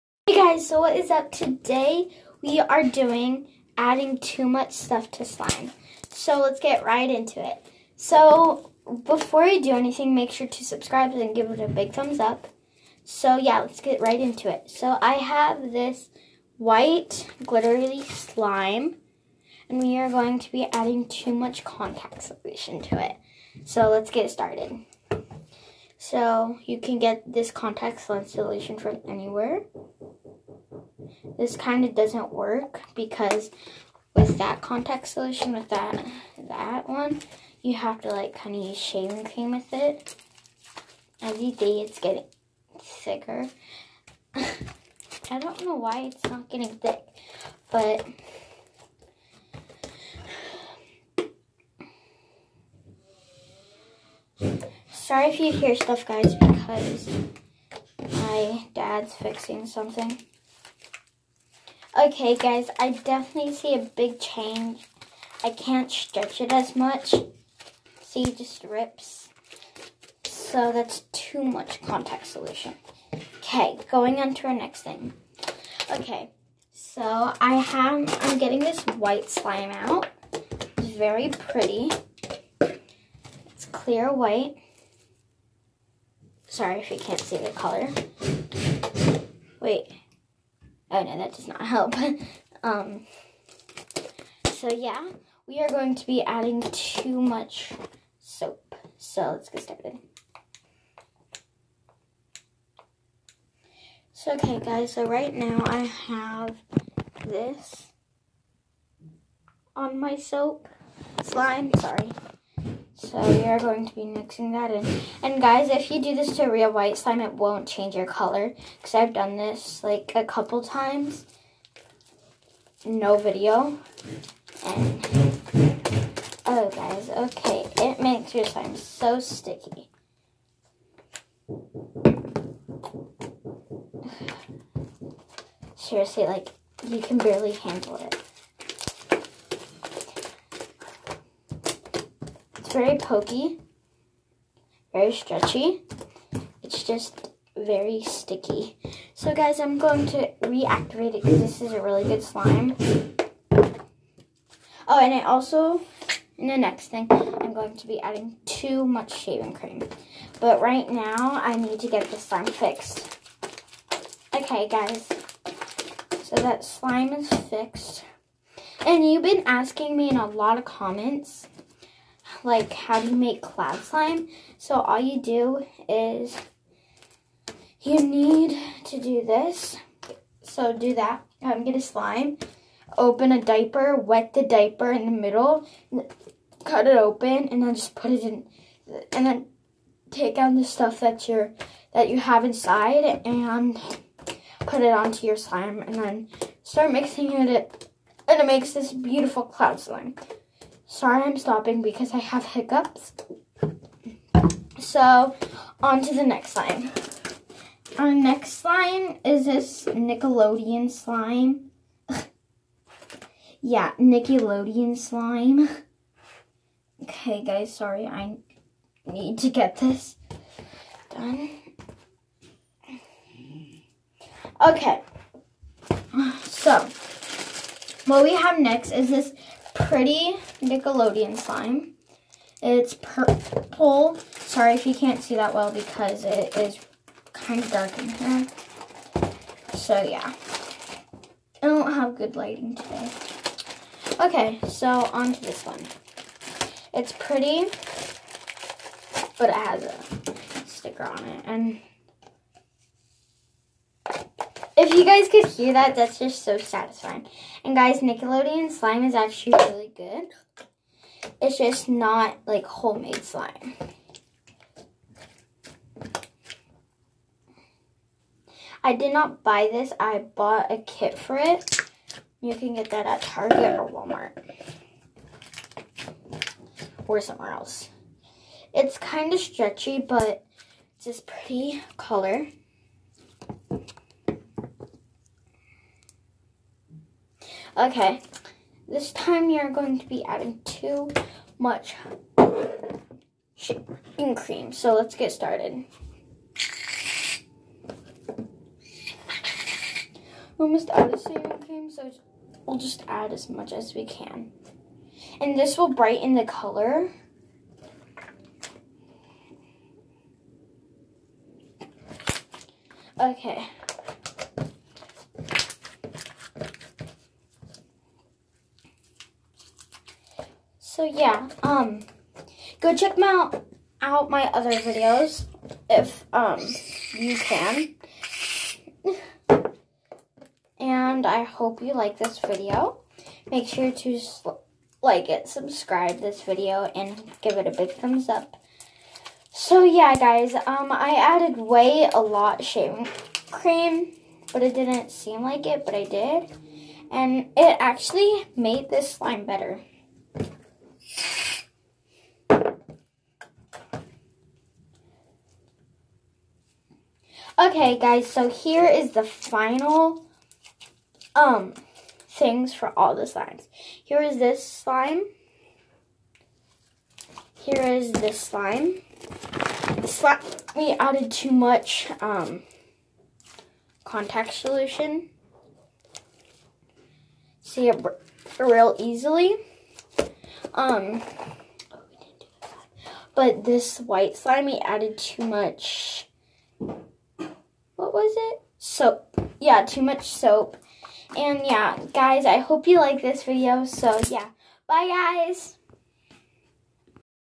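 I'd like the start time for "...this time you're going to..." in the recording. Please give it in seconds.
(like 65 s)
288 s.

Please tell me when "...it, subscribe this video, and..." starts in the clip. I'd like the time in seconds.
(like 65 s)
335 s.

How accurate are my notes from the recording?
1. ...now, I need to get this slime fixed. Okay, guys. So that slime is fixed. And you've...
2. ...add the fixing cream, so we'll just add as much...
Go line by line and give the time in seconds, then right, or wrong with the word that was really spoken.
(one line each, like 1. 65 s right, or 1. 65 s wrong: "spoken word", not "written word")
1. 160 s right
2. 300 s wrong: "shaving", not "fixing".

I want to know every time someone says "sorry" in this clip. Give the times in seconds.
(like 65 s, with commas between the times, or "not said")
54 s, 86 s, 111 s, 200 s, 217 s, 234 s.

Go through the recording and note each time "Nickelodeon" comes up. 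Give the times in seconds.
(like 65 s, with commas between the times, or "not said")
209 s, 213 s, 230 s, 258 s.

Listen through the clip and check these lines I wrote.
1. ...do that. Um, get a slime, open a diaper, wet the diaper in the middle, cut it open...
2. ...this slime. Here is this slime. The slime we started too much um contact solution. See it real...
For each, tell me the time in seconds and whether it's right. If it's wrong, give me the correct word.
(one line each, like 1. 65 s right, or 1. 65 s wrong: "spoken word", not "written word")
1. 180 s right
2. 364 s wrong: "added", not "started".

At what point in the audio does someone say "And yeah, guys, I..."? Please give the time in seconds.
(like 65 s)
391 s.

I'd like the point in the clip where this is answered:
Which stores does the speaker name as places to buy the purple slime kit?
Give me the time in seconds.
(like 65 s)
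273 s.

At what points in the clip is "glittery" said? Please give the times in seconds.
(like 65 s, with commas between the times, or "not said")
17 s.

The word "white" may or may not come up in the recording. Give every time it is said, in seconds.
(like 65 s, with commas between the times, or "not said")
16 s, 78 s, 84 s, 116 s, 383 s.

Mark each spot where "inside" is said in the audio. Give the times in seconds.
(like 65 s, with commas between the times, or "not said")
192 s.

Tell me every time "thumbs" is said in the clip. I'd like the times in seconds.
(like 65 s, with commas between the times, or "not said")
11 s, 337 s.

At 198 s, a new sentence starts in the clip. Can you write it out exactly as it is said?
And it makes this beautiful cloud slime.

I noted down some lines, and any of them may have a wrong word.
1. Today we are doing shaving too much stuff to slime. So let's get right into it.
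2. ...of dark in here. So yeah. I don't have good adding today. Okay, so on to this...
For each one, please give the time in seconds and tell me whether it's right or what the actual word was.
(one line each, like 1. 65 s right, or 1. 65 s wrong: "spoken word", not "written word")
1. 1 s wrong: "adding", not "shaving"
2. 237 s wrong: "lighting", not "adding".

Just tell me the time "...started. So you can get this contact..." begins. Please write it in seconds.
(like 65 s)
24 s.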